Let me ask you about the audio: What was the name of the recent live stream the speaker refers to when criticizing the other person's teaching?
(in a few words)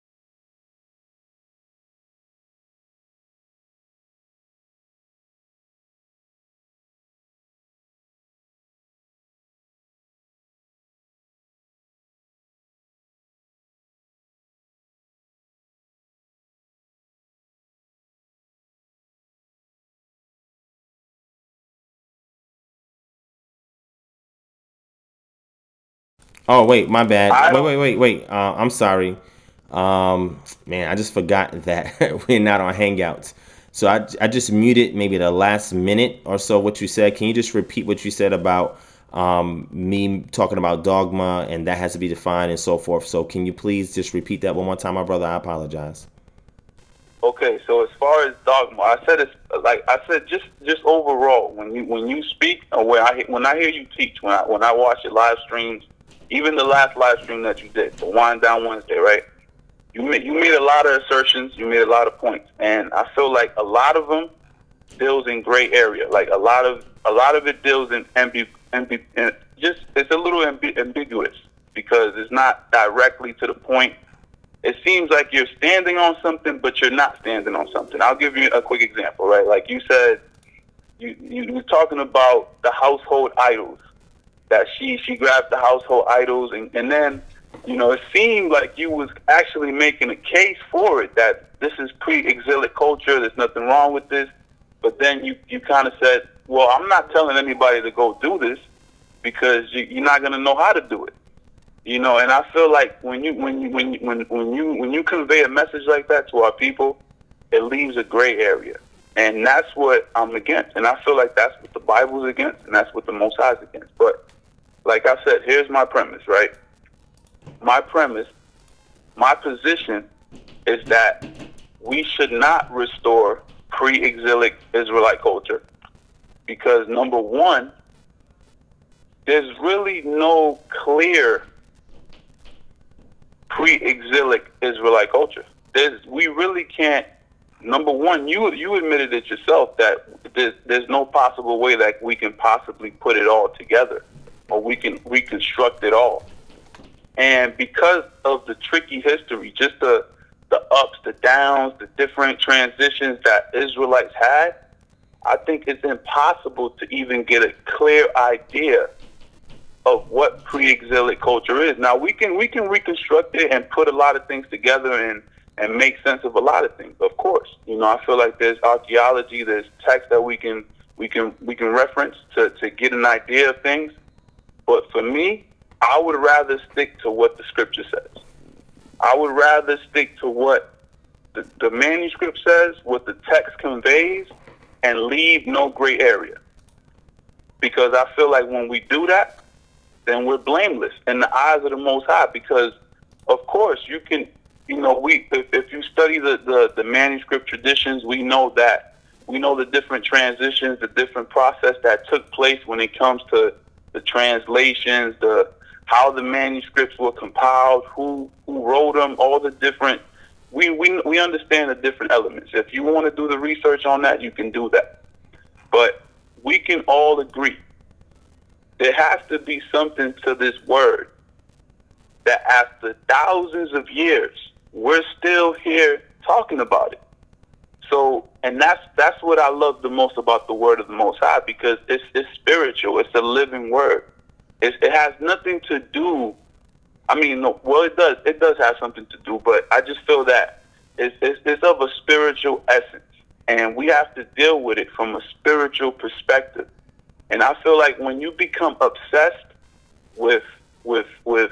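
Wind Down Wednesday.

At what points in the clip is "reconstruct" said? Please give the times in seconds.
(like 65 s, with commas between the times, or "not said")
145 s, 162 s.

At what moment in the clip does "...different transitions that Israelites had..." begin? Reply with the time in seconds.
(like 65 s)
151 s.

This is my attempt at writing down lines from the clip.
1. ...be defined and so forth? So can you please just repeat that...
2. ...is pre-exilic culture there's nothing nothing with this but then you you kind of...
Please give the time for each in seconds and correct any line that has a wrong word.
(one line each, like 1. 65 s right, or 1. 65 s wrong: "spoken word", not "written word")
1. 41 s right
2. 91 s wrong: "wrong", not "nothing".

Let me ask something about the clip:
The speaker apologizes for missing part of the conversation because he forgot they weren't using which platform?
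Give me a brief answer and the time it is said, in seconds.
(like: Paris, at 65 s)
Hangouts, at 32 s.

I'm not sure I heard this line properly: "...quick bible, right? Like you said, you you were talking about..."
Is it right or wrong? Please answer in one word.
wrong.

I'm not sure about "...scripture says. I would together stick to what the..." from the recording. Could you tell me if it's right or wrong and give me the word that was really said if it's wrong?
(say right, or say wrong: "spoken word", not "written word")
wrong: "rather", not "together".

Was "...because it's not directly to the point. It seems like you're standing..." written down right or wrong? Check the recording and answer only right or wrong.
right.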